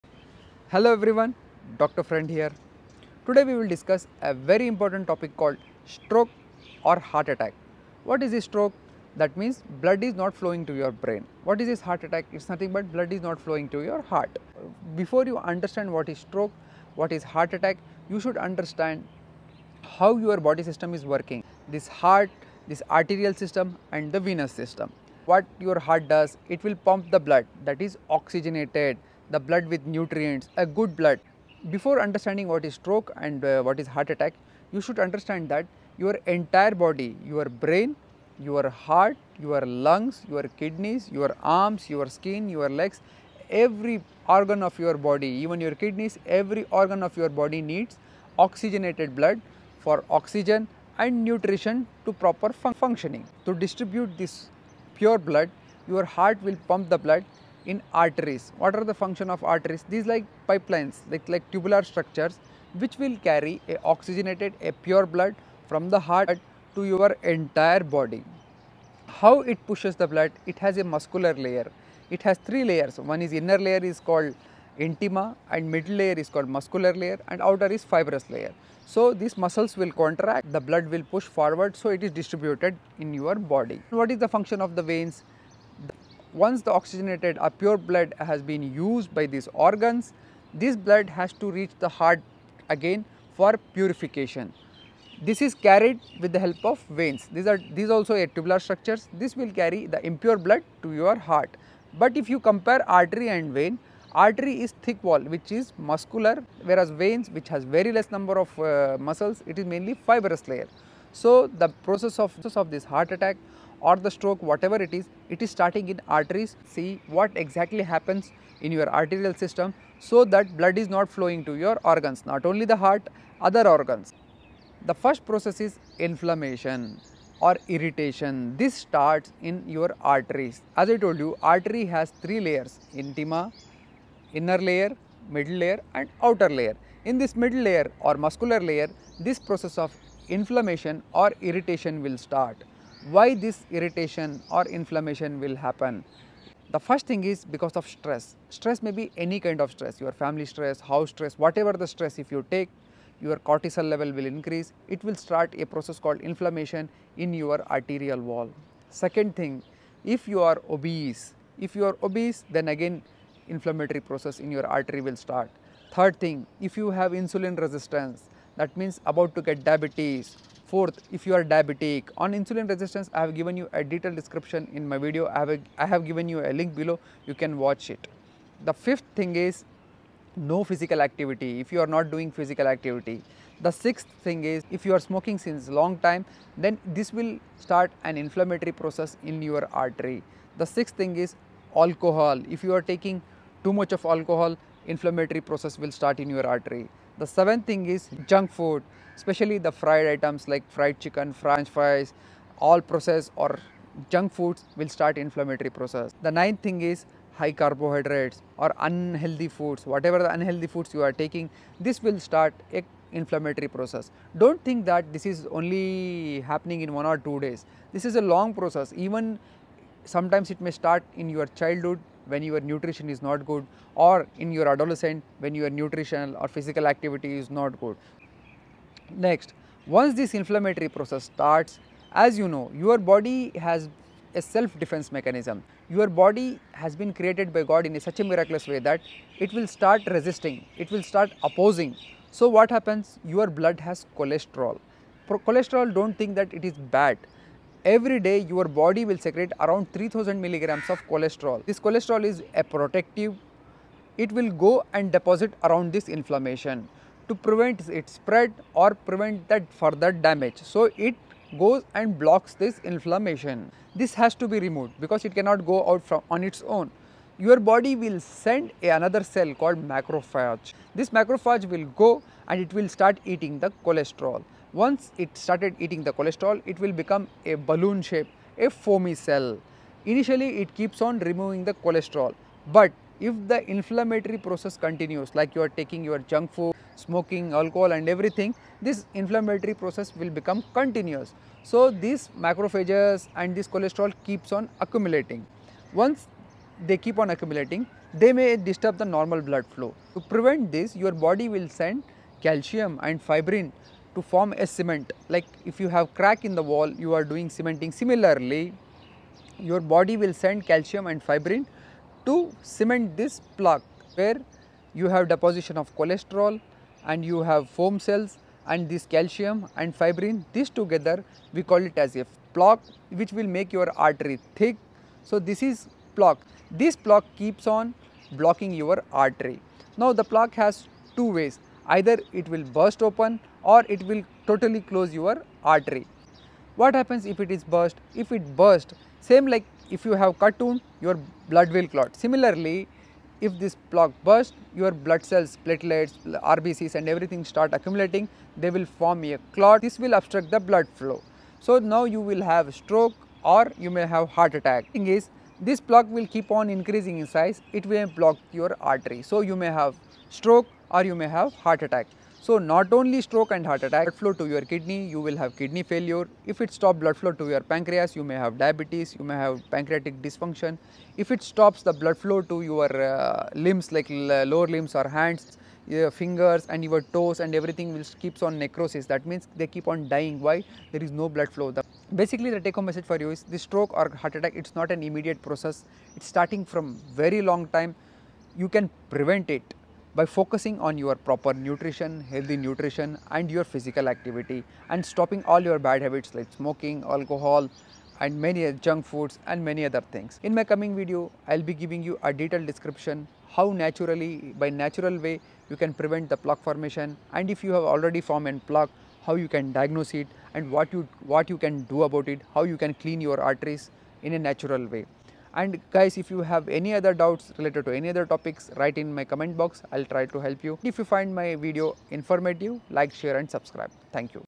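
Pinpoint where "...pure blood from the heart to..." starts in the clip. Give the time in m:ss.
1:04.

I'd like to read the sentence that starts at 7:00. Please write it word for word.
If you find my video informative like share and subscribe.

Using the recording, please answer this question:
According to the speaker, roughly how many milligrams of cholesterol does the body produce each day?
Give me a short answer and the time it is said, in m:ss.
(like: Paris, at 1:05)
3000 milligrams, at 4:09.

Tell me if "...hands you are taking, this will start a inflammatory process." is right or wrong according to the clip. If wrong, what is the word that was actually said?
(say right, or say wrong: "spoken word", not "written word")
wrong: "foods", not "hands".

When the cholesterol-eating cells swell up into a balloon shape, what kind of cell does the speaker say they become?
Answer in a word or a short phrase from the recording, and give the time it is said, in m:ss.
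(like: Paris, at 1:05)
foamy cell, at 4:38.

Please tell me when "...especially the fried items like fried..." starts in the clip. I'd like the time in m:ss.
3:19.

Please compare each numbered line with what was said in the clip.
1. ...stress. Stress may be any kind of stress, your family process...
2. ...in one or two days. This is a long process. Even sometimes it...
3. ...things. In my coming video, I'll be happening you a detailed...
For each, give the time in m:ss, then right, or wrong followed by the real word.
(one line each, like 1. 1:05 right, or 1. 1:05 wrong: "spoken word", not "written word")
1. 2:27 wrong: "stress", not "process"
2. 3:36 right
3. 6:40 wrong: "giving", not "happening".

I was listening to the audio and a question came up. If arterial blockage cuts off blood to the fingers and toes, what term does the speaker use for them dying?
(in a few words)
necrosis.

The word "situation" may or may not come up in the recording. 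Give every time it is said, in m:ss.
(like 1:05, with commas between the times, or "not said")
not said.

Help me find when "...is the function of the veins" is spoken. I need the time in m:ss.
1:24.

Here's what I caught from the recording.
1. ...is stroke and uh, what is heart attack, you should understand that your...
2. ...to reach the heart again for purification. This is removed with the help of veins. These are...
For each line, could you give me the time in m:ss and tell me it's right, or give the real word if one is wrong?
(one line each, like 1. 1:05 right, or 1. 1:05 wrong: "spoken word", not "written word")
1. 0:32 right
2. 1:31 wrong: "carried", not "removed".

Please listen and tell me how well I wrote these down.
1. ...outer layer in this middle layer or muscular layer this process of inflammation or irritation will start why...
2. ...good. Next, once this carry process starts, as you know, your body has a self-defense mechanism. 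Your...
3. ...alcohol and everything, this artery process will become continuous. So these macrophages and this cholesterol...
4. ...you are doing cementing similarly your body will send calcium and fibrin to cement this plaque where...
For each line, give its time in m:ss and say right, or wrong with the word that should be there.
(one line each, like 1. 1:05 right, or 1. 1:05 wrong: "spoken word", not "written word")
1. 2:16 right
2. 3:47 wrong: "inflammatory", not "carry"
3. 4:47 wrong: "inflammatory", not "artery"
4. 5:07 right.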